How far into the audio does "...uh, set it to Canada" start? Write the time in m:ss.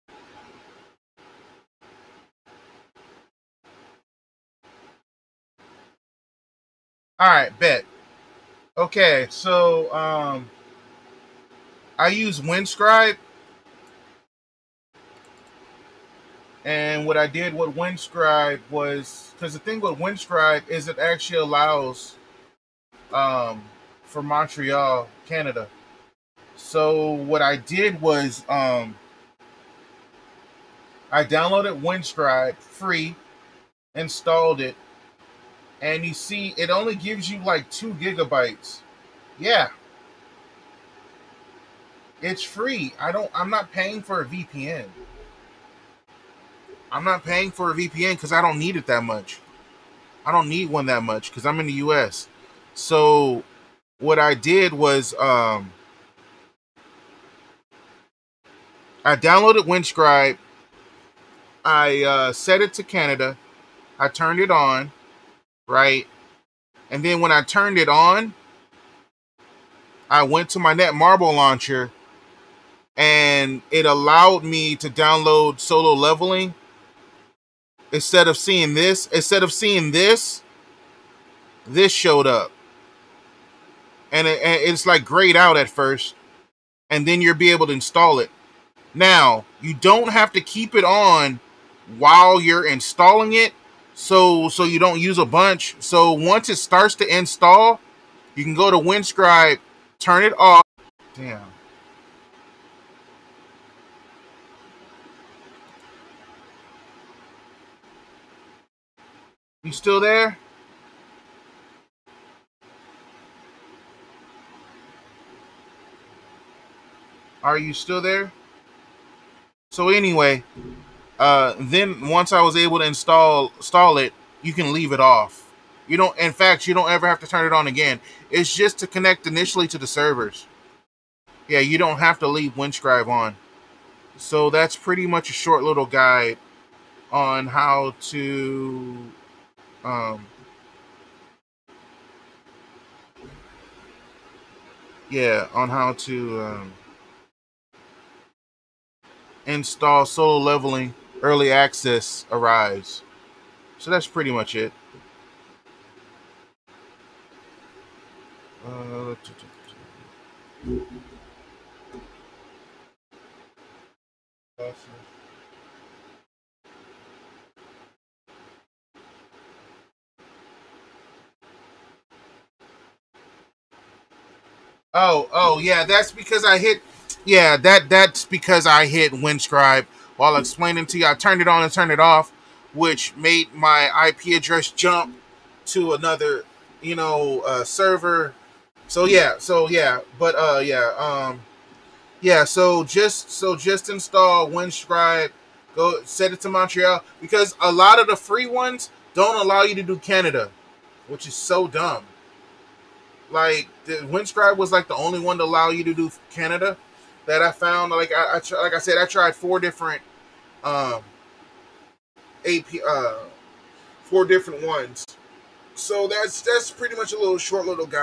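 1:02.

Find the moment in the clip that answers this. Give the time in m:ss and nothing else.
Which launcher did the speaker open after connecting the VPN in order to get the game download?
1:10.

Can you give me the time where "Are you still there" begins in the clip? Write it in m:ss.
1:57.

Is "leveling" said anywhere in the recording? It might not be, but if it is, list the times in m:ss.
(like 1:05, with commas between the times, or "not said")
1:15, 2:30.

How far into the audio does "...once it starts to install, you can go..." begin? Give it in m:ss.
1:36.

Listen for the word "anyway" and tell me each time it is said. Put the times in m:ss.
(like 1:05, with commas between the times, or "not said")
1:59.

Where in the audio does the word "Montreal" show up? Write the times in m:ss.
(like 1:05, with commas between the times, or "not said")
0:24, 3:16.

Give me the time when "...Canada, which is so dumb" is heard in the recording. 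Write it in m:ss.
3:19.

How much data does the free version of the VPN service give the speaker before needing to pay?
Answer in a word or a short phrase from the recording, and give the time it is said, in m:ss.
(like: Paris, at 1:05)
2 gigabytes, at 0:37.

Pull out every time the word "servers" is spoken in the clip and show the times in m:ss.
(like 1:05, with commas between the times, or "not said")
2:09, 3:07.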